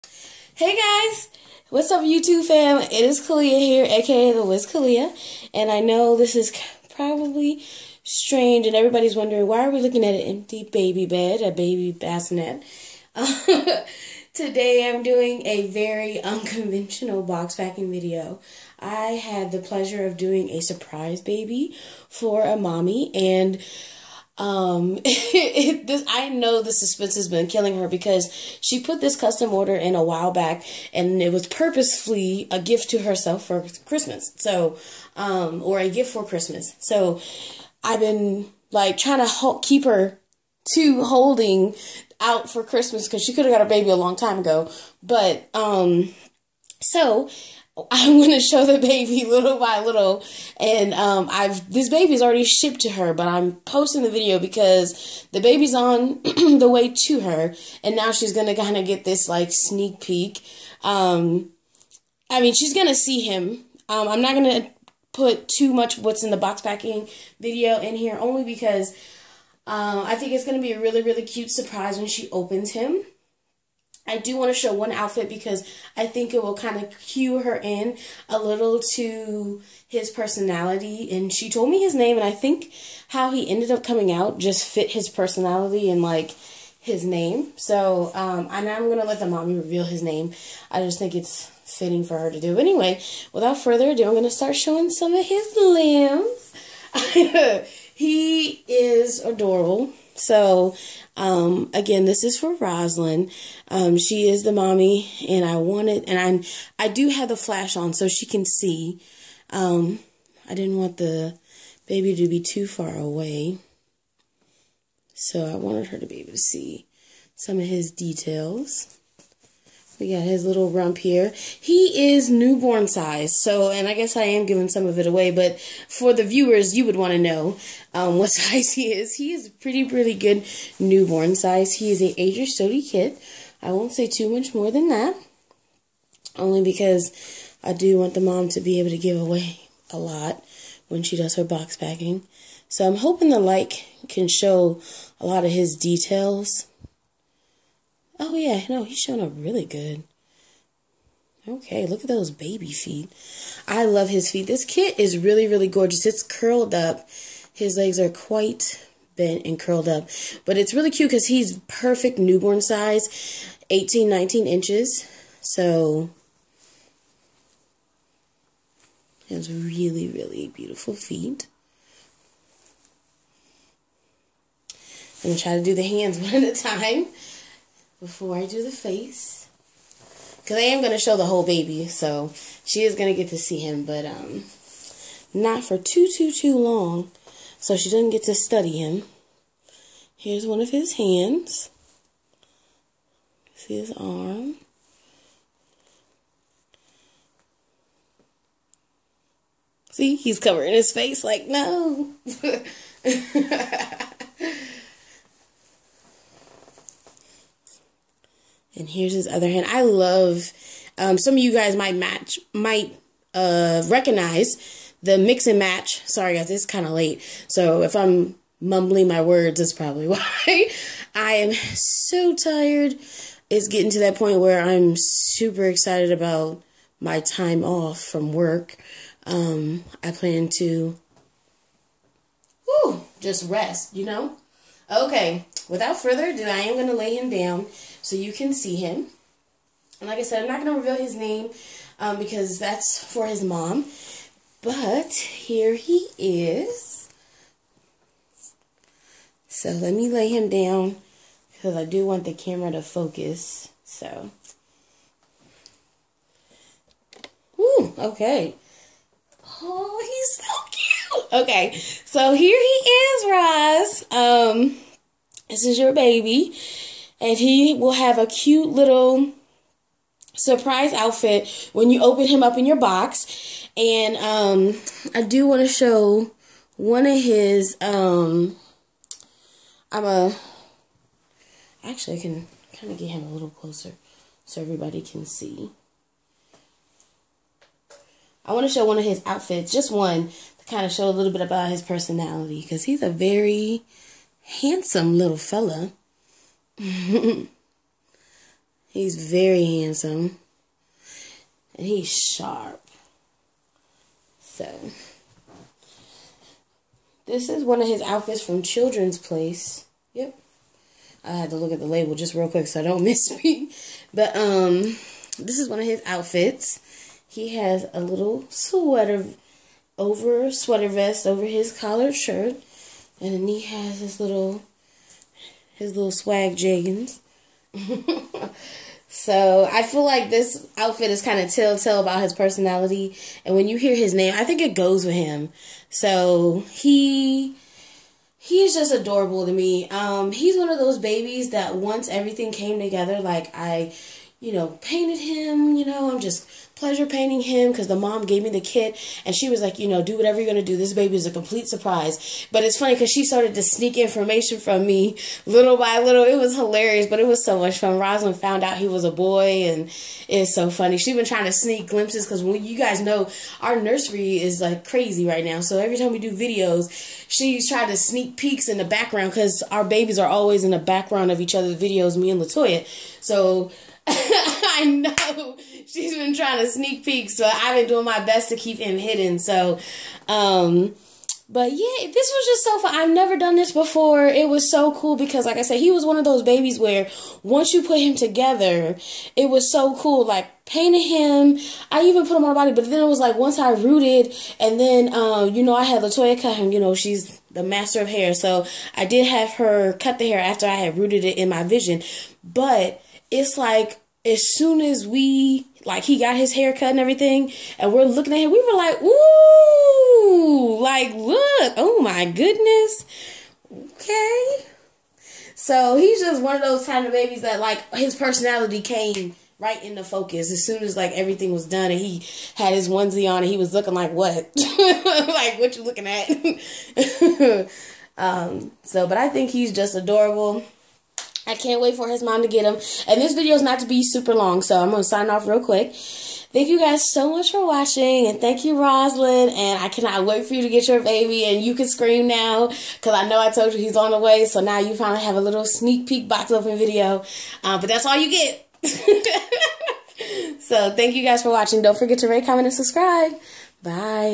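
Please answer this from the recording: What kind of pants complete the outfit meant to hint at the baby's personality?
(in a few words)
jeggings.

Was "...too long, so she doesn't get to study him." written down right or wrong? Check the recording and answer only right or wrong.
right.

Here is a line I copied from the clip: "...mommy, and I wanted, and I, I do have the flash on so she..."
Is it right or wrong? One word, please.
right.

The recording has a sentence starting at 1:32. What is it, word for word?
anyway, without further ado, I'm gonna start showing some of his limbs.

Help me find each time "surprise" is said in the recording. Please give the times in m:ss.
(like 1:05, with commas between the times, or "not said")
0:20, 1:11, 4:30, 5:51.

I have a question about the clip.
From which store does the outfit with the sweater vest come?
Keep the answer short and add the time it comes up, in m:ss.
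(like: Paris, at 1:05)
Children's Place, at 5:08.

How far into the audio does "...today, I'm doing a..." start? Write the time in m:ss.
0:14.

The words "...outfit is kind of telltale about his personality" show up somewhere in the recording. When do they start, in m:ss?
5:30.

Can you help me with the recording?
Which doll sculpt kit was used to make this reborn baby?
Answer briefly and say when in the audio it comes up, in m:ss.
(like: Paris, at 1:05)
Adrie Stote, at 2:12.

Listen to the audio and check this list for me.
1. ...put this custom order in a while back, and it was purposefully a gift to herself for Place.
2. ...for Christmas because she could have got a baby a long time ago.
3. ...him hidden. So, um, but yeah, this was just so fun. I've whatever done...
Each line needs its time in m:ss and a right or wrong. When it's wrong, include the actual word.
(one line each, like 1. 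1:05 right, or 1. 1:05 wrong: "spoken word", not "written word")
1. 0:28 wrong: "Christmas", not "Place"
2. 0:42 right
3. 6:18 wrong: "never", not "whatever".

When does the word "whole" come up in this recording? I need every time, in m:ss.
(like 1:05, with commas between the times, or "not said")
3:01.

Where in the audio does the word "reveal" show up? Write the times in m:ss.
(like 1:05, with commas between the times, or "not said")
1:29, 4:00.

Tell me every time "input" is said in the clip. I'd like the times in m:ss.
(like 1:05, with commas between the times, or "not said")
not said.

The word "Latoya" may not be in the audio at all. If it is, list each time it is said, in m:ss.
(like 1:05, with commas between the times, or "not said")
6:12, 6:36.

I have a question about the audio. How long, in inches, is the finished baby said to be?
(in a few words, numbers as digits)
18, 19 inches.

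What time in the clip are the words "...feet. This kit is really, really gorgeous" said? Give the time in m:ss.
2:34.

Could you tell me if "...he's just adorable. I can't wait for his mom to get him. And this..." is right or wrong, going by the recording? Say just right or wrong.
right.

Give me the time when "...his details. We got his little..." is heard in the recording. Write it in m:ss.
1:57.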